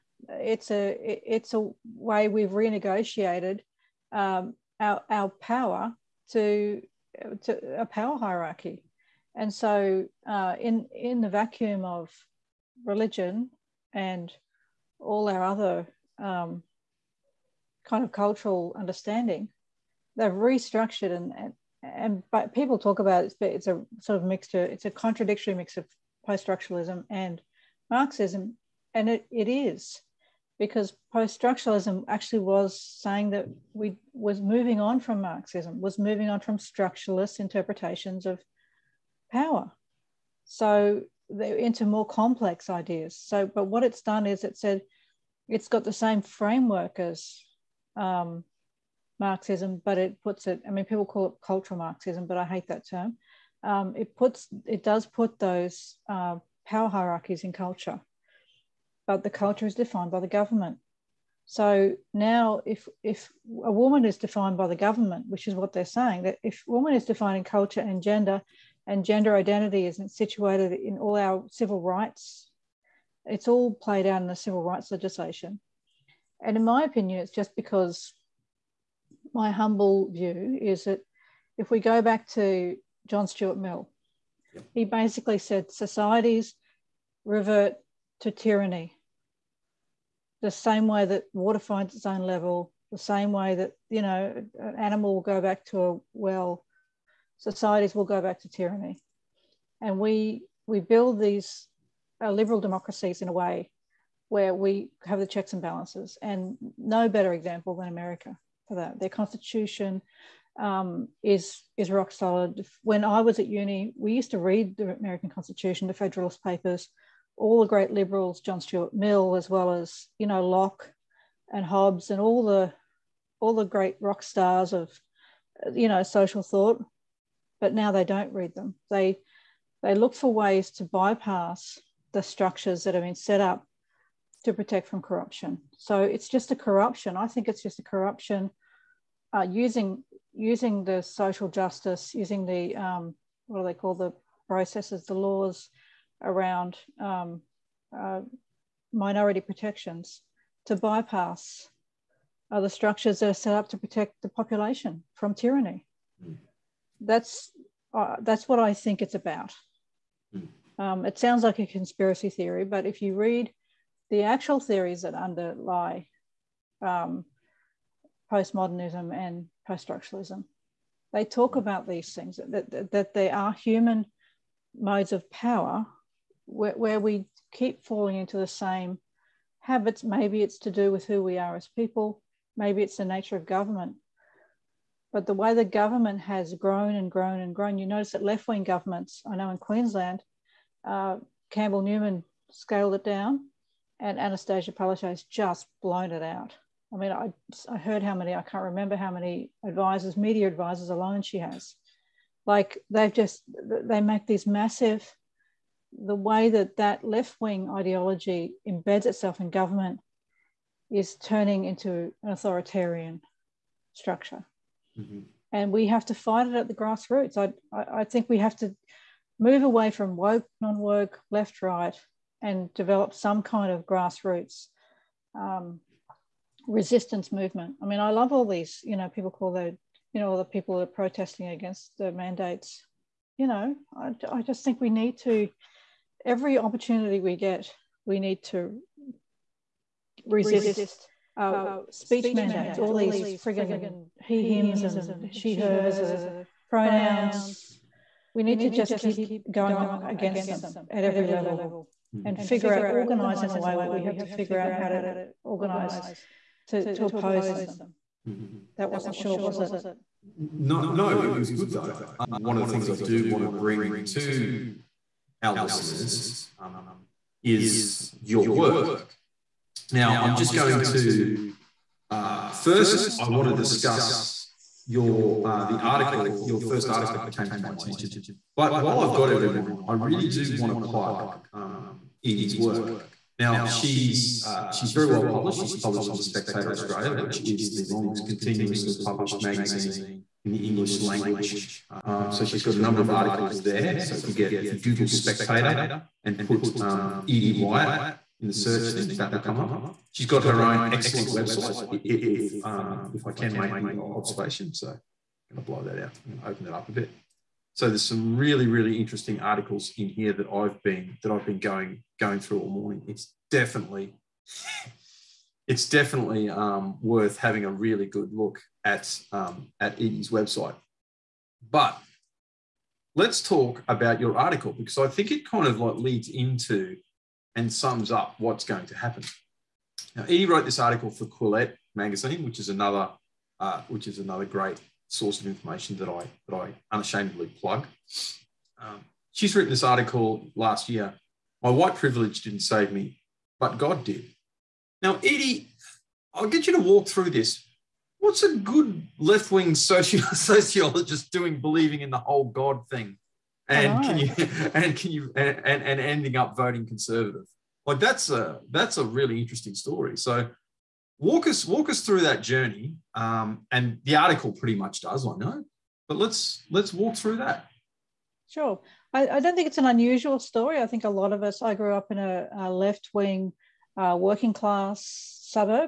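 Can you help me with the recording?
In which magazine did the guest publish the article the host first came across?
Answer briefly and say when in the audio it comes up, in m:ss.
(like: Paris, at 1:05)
Quillette, at 5:31.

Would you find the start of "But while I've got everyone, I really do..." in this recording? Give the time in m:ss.
4:38.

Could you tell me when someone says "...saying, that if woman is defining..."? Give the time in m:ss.
1:05.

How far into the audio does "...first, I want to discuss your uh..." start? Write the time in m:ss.
4:32.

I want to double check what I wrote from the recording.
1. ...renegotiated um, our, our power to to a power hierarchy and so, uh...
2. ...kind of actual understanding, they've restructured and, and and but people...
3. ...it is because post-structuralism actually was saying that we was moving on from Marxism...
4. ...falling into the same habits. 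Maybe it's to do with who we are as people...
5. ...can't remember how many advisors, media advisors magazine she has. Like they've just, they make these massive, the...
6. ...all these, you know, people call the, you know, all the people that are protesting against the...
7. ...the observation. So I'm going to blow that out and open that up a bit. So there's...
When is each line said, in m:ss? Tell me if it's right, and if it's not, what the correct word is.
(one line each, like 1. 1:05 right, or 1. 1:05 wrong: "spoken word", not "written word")
1. 0:02 right
2. 0:17 wrong: "cultural", not "actual"
3. 0:29 right
4. 2:57 right
5. 3:18 wrong: "alone", not "magazine"
6. 3:48 right
7. 5:03 right.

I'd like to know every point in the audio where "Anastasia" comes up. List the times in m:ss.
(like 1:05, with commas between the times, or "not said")
3:14.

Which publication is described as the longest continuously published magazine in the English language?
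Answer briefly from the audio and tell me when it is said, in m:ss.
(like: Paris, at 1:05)
Spectator Australia, at 4:46.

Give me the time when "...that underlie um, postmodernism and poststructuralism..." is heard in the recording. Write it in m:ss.
2:45.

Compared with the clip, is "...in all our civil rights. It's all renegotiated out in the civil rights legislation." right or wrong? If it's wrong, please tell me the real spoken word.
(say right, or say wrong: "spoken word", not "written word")
wrong: "played", not "renegotiated".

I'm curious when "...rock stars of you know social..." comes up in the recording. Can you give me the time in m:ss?
2:04.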